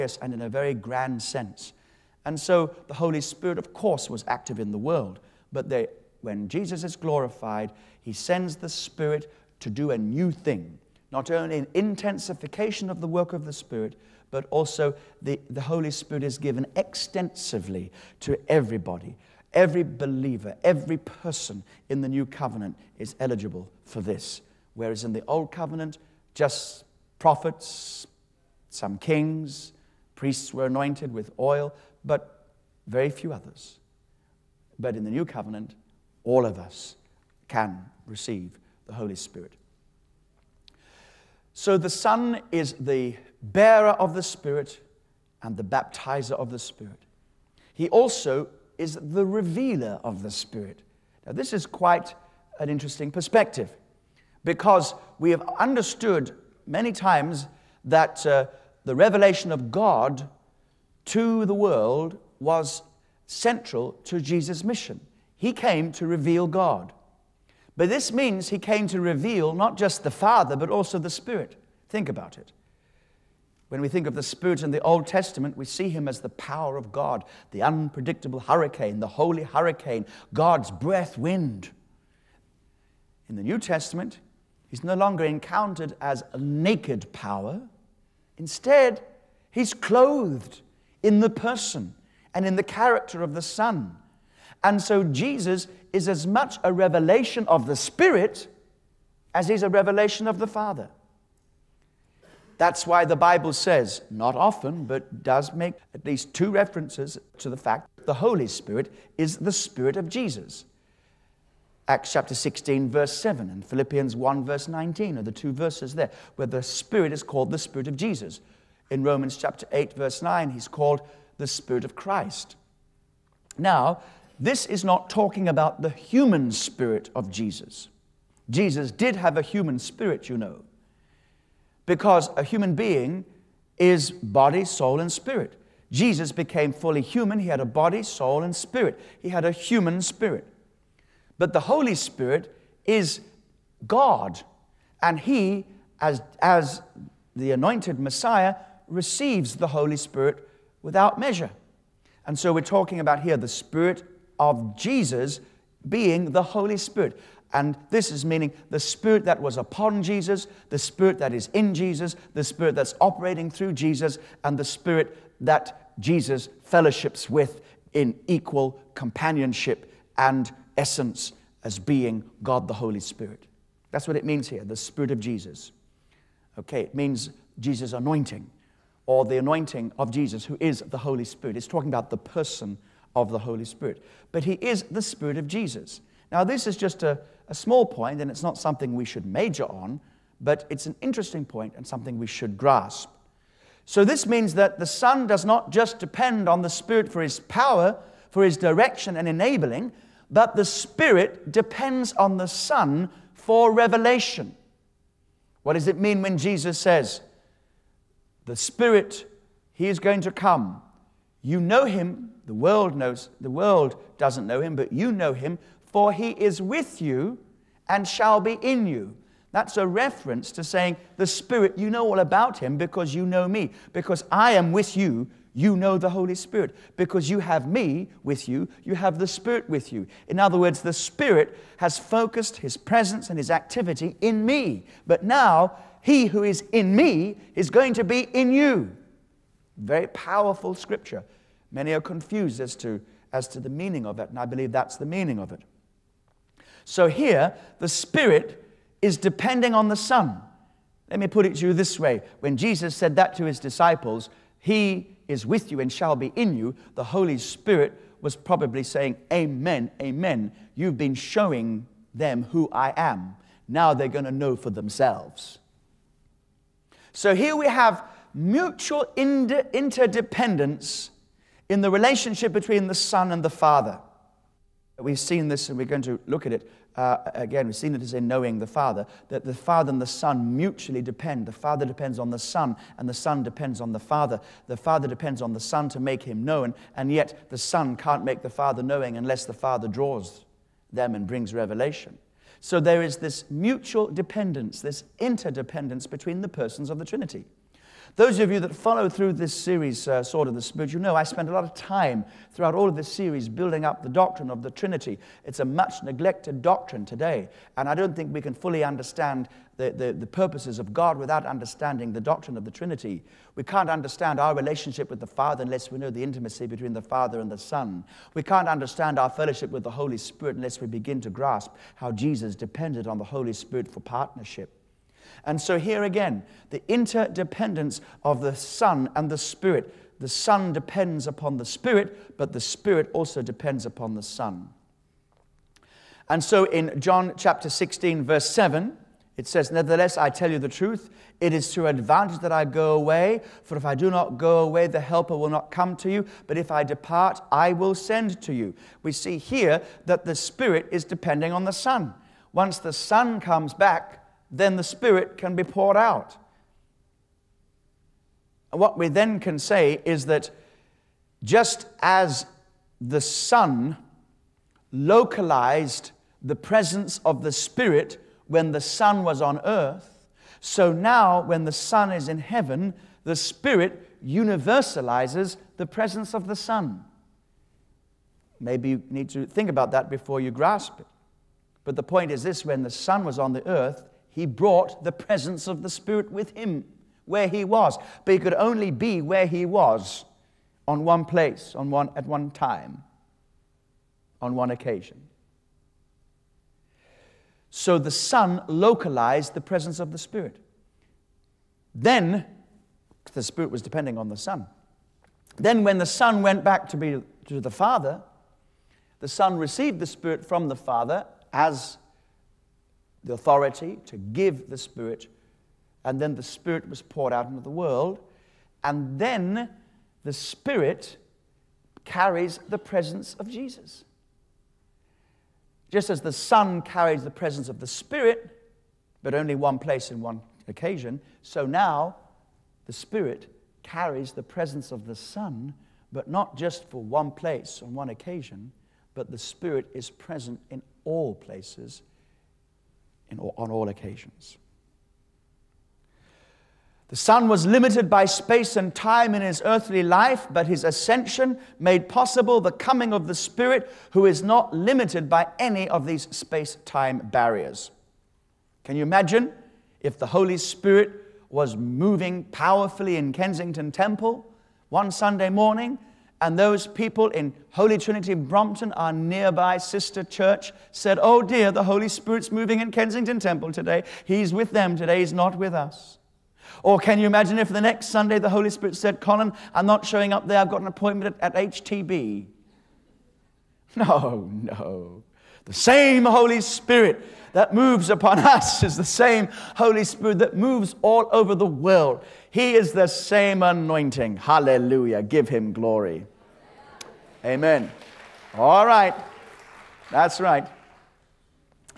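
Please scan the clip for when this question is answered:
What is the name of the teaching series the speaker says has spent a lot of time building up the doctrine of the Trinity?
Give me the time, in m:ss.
5:00.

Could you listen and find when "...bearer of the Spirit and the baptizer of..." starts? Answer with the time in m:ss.
0:43.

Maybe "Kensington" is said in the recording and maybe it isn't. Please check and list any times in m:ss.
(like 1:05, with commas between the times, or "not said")
7:43, 7:52.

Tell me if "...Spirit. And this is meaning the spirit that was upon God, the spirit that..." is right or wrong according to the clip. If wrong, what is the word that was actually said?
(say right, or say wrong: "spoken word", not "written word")
wrong: "Jesus", not "God".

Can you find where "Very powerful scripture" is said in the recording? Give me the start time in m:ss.
3:59.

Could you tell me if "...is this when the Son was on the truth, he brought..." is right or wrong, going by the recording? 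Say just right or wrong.
wrong.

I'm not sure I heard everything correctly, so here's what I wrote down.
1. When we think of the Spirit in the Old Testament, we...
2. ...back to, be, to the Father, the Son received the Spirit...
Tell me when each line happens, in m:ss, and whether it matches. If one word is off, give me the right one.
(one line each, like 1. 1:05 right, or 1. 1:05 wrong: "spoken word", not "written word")
1. 1:13 right
2. 6:46 right.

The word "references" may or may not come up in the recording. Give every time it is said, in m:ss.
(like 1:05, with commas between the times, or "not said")
1:46, 3:39.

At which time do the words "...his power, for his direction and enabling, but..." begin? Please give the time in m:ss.
3:17.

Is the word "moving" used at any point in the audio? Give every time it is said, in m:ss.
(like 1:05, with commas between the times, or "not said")
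7:41, 7:52.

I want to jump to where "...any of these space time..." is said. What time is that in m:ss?
7:35.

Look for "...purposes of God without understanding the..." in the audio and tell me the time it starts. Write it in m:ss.
5:10.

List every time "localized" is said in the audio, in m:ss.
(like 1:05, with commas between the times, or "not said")
6:04, 6:38.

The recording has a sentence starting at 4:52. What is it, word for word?
So there is this mutual dependence, this interdependence between the persons of the Trinity.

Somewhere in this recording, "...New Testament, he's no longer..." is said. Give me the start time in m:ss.
1:23.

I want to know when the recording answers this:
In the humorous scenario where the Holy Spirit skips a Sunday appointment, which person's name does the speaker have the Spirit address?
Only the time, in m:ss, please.
7:59.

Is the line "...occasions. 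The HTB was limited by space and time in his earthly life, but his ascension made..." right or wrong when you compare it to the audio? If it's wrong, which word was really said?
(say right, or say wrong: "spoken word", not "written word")
wrong: "Son", not "HTB".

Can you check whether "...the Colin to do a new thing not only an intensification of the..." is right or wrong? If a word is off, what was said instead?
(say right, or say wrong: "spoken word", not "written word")
wrong: "Spirit", not "Colin".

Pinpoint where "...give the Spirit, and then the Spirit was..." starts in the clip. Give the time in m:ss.
6:54.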